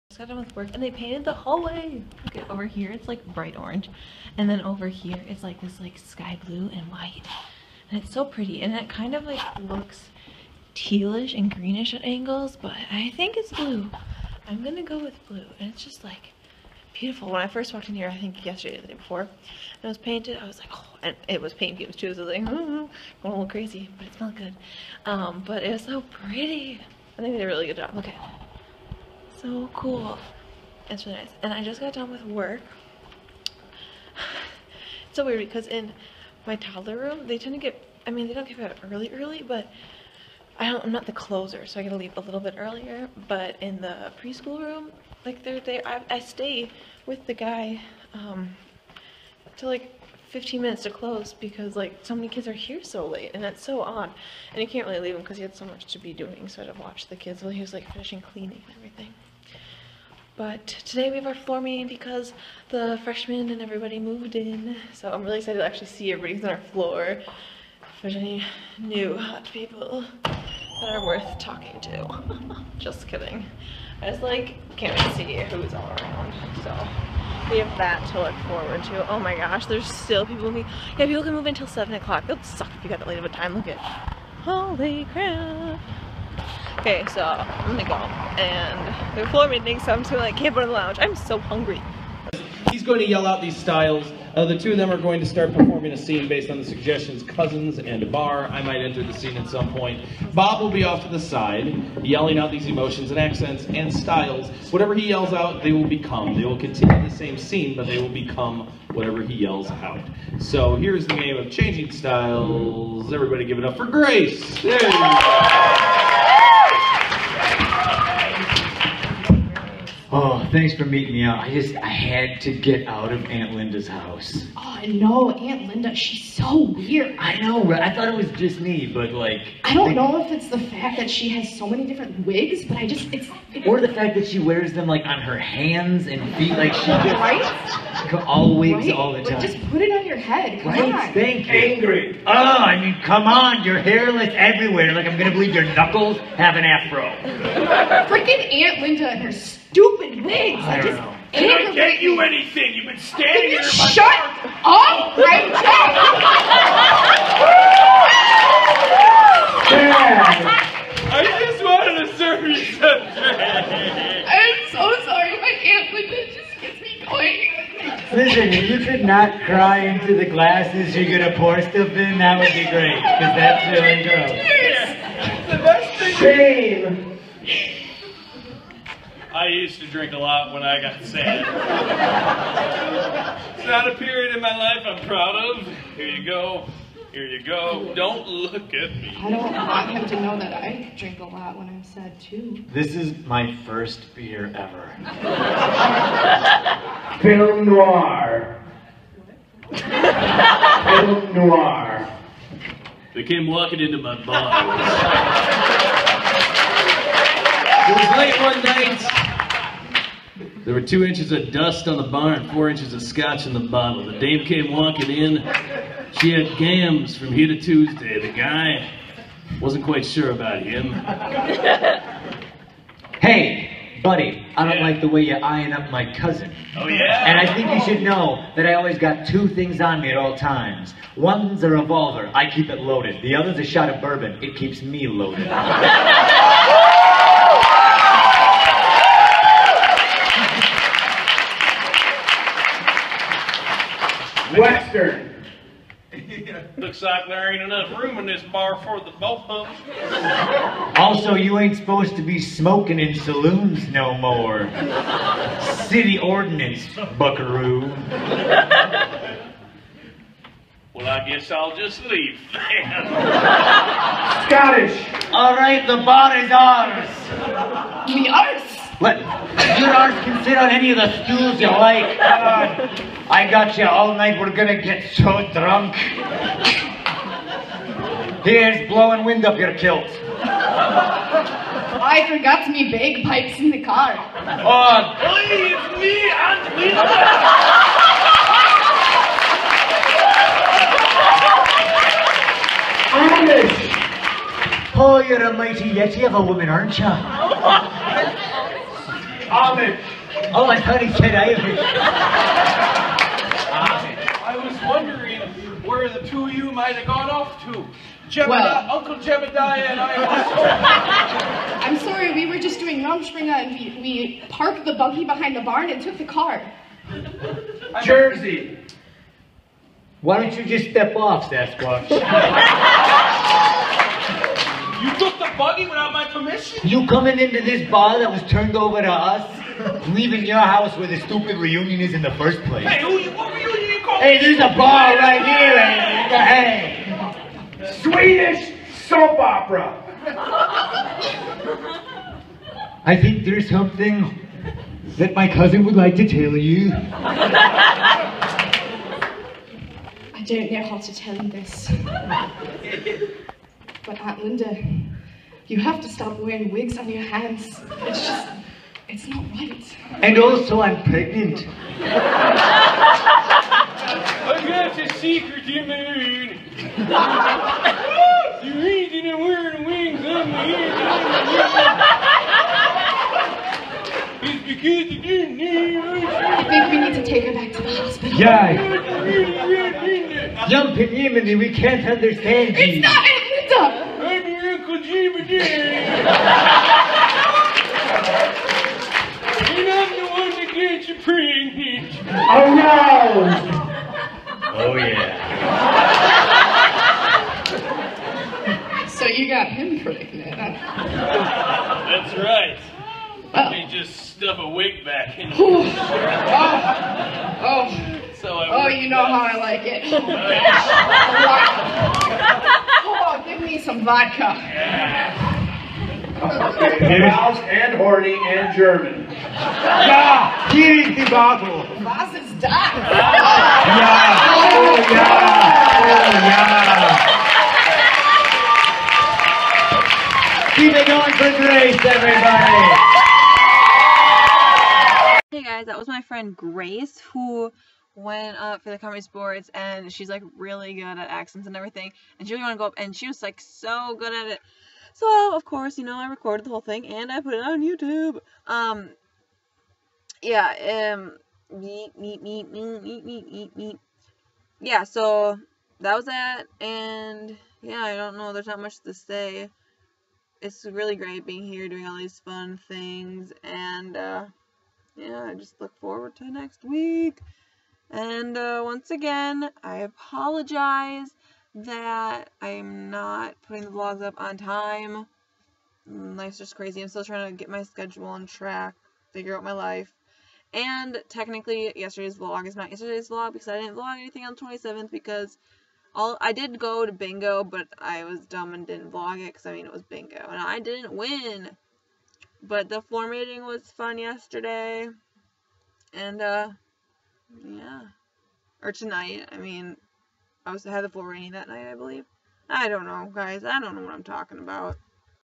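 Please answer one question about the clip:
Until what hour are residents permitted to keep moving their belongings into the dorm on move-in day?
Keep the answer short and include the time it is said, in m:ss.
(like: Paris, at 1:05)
7 o'clock, at 1:21.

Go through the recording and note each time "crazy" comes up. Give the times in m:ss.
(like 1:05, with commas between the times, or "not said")
0:23, 7:56.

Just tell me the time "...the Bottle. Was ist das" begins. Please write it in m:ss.
7:01.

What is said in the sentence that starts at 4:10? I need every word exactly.
Also, you ain't supposed to be smoking in saloons no more.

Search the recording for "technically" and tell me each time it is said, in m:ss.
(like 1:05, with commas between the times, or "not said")
8:01.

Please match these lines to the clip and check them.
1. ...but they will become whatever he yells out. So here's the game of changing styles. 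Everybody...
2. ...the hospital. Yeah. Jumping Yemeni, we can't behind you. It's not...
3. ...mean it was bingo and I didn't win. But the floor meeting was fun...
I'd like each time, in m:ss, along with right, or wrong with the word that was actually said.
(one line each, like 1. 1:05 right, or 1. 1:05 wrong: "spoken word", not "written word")
1. 1:47 right
2. 6:17 wrong: "understand", not "behind"
3. 8:09 right.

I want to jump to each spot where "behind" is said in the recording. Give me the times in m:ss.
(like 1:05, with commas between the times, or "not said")
5:15.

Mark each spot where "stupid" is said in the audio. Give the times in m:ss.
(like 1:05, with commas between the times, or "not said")
2:29, 5:31.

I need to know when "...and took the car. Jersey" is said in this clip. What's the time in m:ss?
5:15.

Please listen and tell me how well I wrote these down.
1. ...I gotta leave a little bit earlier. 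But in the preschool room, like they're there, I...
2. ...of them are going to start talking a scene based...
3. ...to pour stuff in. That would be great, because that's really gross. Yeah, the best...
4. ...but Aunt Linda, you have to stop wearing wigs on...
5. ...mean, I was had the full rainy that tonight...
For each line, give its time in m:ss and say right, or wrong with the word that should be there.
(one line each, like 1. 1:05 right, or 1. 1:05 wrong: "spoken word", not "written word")
1. 0:41 right
2. 1:34 wrong: "performing", not "talking"
3. 2:51 right
4. 5:54 right
5. 8:19 wrong: "night", not "tonight".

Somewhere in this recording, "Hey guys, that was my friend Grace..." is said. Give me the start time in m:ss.
7:15.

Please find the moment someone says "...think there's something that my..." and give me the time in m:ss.
5:43.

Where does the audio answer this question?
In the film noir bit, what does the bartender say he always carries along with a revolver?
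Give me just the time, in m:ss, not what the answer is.
3:53.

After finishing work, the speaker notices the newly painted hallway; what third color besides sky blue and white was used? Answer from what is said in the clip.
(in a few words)
bright orange.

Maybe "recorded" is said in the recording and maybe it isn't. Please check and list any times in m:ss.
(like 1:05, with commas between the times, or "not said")
7:26.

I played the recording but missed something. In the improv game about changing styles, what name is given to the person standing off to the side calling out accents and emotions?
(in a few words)
Bob.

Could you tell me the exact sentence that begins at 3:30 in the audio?
There were two inches of dust on the bar and four inches of scotch in the bottle.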